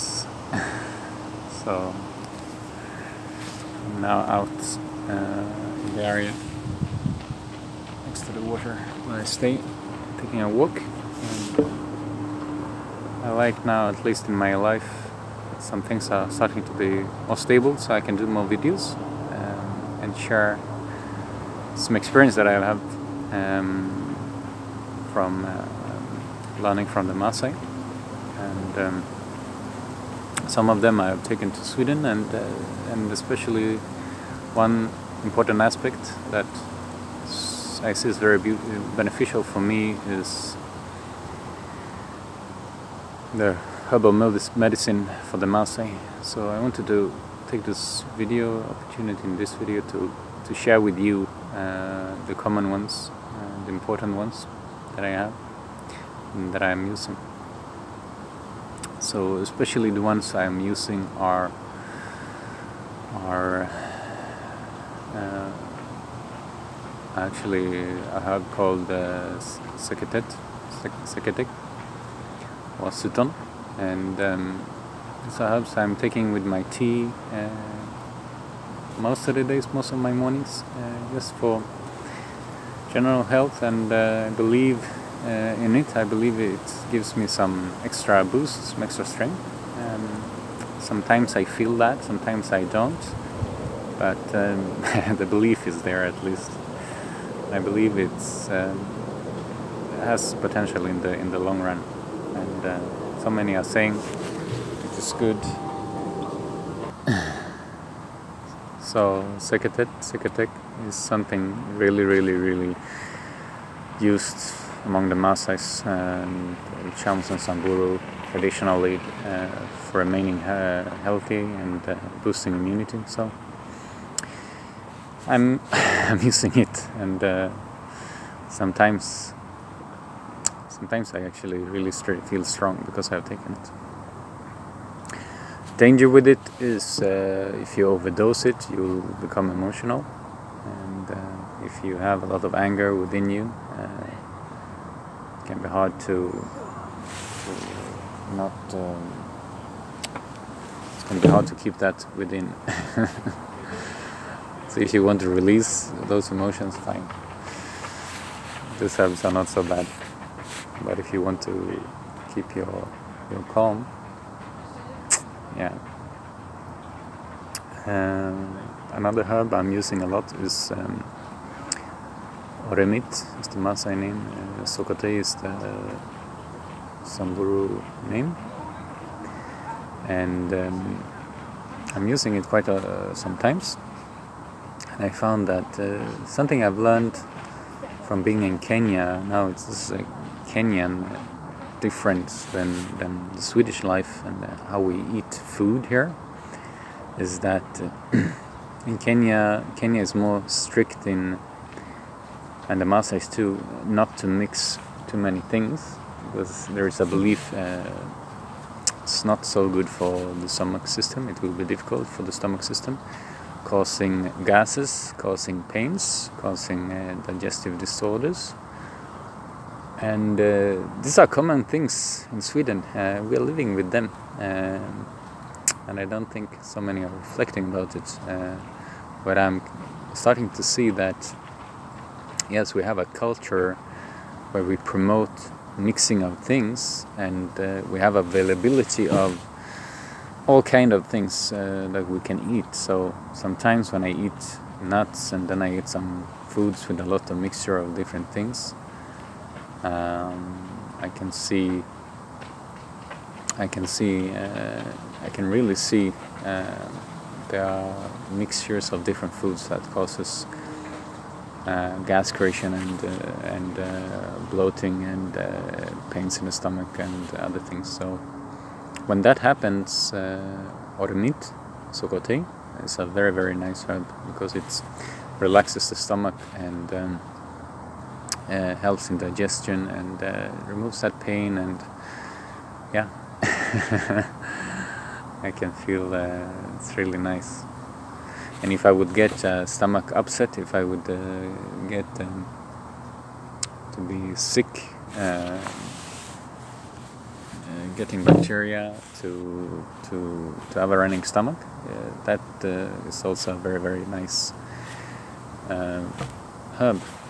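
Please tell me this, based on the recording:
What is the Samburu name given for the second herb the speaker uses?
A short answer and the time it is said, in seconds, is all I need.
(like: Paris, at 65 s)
Sokate, at 174 s.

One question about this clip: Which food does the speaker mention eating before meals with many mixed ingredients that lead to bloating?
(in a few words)
Nuts.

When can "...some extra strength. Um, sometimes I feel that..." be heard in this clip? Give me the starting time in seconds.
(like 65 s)
88 s.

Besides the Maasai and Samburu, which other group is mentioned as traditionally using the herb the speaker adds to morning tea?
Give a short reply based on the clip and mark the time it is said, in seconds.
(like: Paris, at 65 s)
Chams, at 117 s.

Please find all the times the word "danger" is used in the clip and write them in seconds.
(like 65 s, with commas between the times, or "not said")
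135 s.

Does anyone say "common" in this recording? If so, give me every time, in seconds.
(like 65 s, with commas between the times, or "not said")
52 s, 221 s.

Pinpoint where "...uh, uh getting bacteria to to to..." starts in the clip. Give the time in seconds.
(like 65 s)
295 s.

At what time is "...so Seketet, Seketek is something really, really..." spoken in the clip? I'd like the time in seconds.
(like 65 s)
108 s.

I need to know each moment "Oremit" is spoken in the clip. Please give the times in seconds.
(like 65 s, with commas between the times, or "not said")
270 s.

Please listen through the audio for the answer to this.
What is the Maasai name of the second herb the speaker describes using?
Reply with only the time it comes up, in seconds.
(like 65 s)
172 s.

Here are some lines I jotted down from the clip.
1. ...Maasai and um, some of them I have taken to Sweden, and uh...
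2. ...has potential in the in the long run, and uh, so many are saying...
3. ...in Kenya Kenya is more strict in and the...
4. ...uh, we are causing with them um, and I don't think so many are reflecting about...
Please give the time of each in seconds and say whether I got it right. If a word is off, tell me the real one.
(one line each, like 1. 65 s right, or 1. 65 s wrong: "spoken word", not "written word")
1. 27 s right
2. 100 s right
3. 198 s right
4. 222 s wrong: "living", not "causing".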